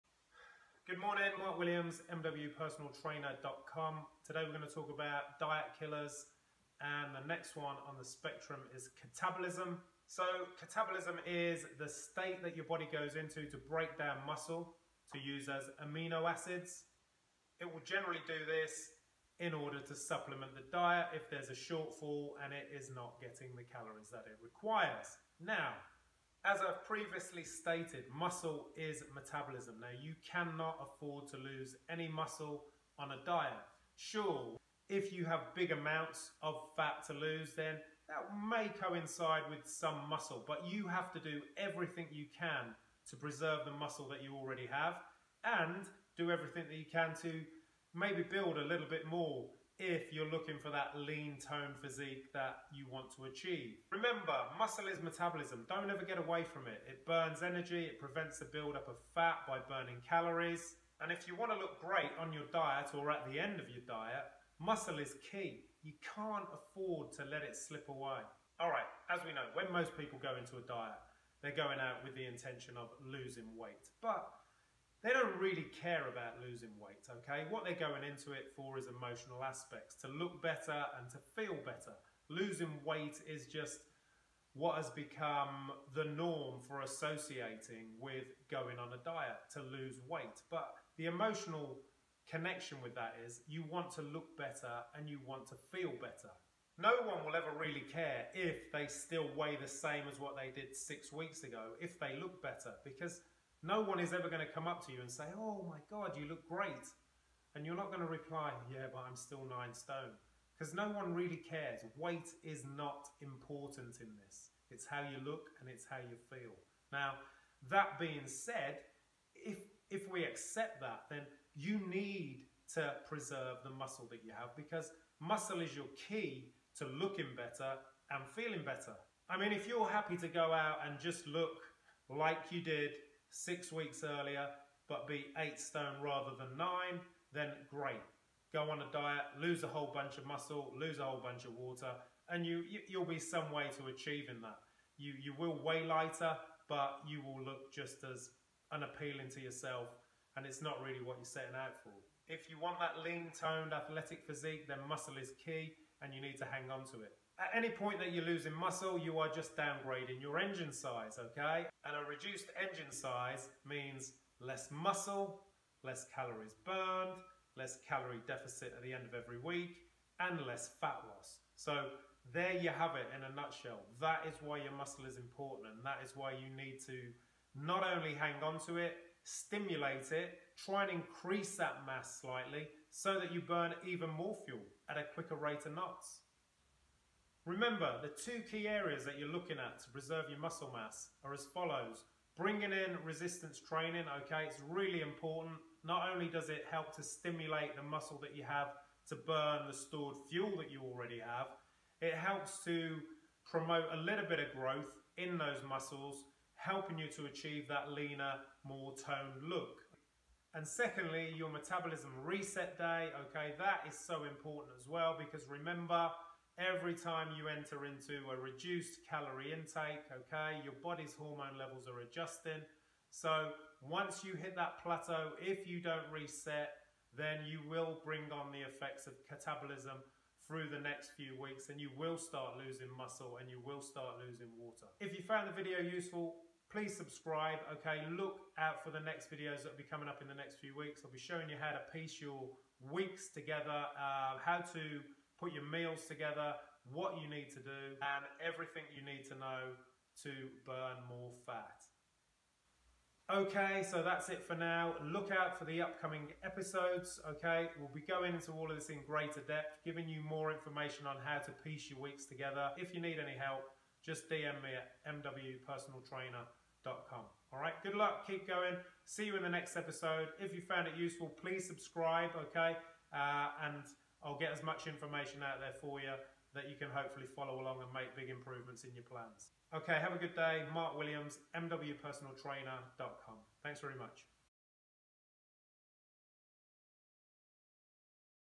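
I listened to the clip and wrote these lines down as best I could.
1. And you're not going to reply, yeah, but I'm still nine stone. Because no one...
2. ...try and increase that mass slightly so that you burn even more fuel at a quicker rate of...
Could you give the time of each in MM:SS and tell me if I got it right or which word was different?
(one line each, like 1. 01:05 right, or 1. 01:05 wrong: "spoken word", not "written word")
1. 01:47 right
2. 03:00 right.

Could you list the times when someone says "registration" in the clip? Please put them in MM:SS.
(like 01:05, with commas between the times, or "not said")
not said.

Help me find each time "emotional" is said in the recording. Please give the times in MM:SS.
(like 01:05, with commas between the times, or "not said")
01:18, 01:31.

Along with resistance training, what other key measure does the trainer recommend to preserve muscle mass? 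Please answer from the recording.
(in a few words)
Metabolism reset day.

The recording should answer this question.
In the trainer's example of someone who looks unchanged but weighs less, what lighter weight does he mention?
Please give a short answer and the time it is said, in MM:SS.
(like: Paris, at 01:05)
8 stone, at 02:15.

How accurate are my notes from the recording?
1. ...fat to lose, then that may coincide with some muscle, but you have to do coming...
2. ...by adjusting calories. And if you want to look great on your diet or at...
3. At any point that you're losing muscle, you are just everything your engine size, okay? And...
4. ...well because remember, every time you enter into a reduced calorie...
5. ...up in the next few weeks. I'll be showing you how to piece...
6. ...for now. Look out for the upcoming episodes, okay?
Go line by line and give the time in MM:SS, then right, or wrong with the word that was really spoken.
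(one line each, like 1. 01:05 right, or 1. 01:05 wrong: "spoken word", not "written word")
1. 00:36 wrong: "everything", not "coming"
2. 00:59 wrong: "burning", not "adjusting"
3. 02:37 wrong: "downgrading", not "everything"
4. 03:34 right
5. 04:00 right
6. 04:14 right.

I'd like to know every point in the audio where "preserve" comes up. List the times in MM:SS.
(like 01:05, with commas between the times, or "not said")
00:43, 02:03, 03:09.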